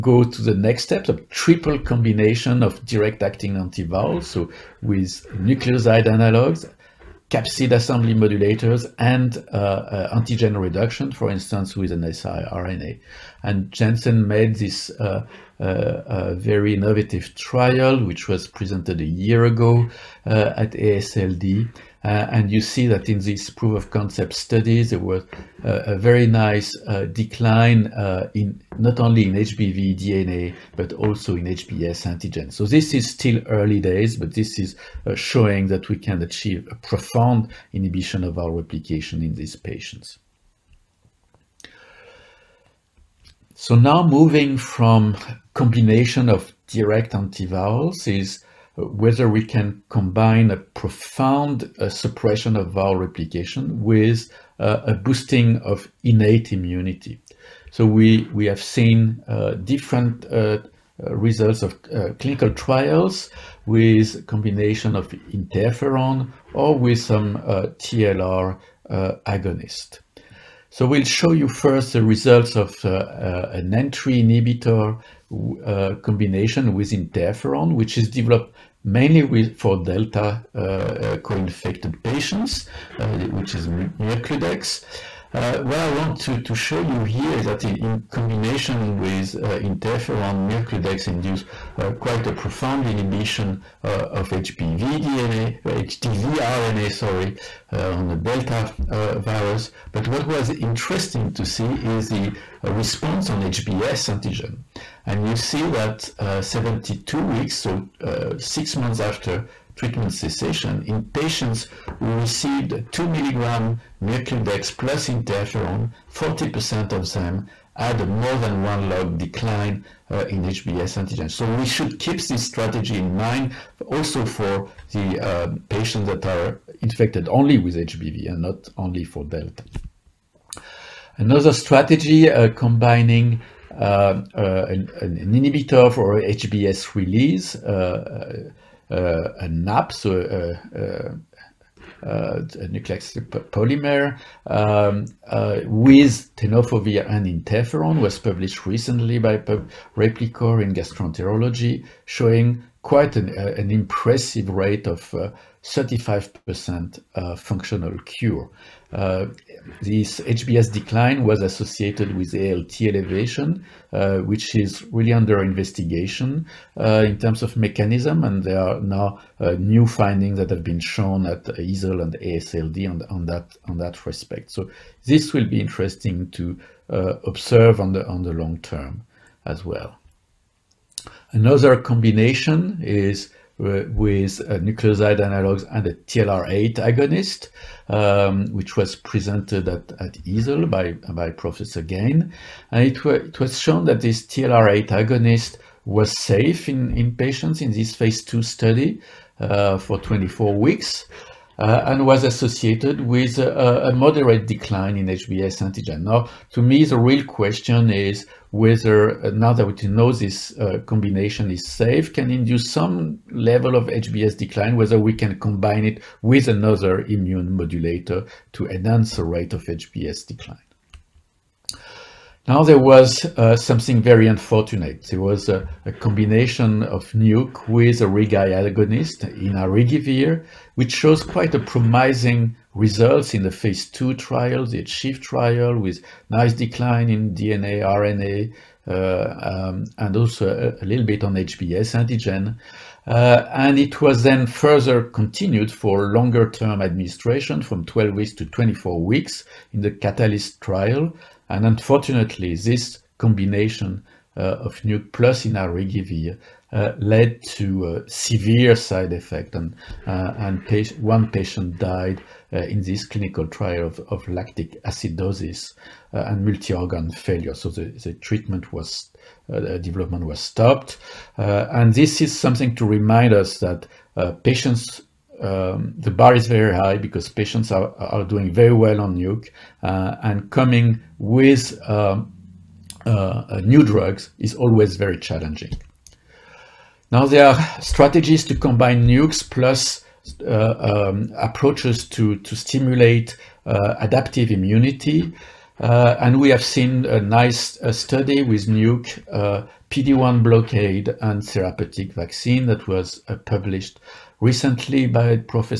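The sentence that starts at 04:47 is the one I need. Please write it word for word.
Now there are strategies to combine nukes plus uh, um, approaches to, to stimulate uh, adaptive immunity.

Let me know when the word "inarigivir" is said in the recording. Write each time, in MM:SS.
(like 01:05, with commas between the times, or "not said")
03:49, 04:15.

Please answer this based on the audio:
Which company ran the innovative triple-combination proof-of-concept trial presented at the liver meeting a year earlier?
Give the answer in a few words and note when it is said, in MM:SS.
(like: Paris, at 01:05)
Janssen, at 00:13.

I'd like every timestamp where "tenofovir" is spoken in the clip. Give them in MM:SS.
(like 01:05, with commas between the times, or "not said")
02:26.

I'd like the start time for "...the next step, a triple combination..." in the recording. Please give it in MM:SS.
00:00.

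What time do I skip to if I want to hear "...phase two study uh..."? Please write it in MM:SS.
03:17.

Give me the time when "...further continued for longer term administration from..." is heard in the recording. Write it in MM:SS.
04:04.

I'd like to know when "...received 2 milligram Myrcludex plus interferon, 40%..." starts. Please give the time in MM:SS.
01:52.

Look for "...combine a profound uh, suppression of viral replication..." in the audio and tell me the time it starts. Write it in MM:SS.
00:49.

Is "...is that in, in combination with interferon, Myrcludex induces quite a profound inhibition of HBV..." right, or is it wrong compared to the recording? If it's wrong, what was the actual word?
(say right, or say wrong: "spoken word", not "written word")
right.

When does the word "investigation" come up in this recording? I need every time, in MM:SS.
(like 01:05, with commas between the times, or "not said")
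02:45.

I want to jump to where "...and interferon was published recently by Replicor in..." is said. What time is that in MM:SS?
02:27.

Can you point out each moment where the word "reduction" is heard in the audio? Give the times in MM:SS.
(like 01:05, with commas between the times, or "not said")
00:10.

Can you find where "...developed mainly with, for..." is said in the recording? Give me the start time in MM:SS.
01:18.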